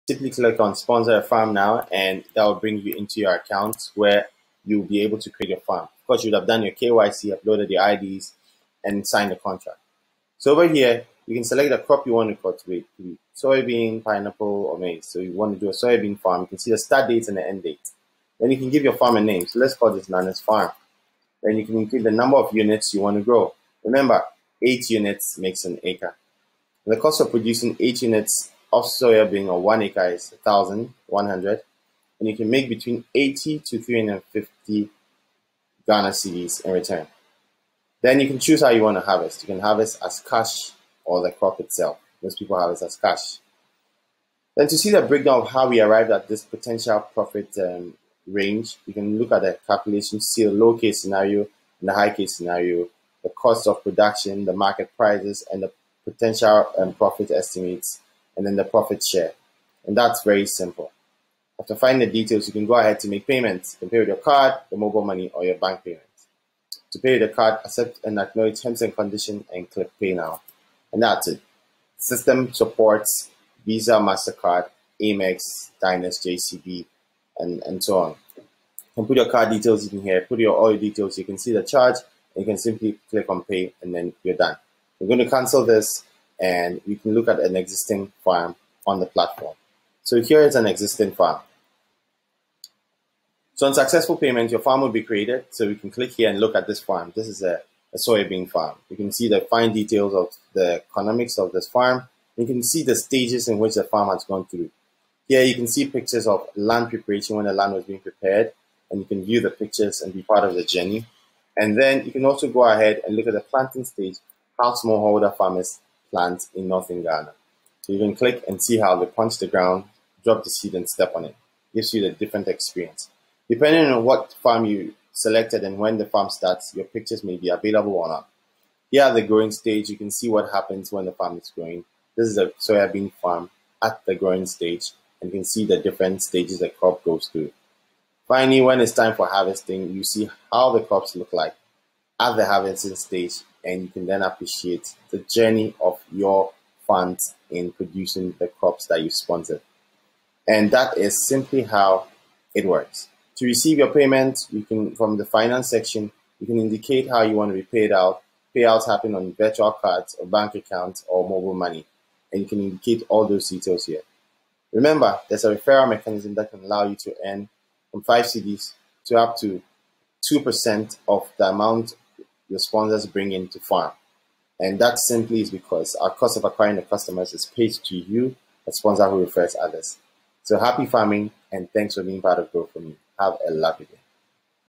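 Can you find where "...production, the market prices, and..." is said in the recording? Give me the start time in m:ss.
0:53.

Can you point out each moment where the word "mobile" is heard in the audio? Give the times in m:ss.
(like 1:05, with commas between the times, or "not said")
1:04, 2:41.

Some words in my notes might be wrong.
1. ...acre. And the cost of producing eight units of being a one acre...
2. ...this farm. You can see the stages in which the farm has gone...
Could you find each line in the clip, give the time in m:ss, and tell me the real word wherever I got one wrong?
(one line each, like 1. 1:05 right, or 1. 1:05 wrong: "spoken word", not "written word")
1. 0:25 right
2. 1:41 right.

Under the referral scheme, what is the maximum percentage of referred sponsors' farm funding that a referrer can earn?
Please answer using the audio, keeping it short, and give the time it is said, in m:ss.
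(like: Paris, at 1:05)
2%, at 2:50.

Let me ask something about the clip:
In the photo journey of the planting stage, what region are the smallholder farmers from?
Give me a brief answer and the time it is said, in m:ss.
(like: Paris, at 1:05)
Northern Ghana, at 1:56.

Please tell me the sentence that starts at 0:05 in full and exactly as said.
Of course, you'd have done your KYC, uploaded your IDs and signed the contract.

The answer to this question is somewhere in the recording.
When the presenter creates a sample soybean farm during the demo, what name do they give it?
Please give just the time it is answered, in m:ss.
0:20.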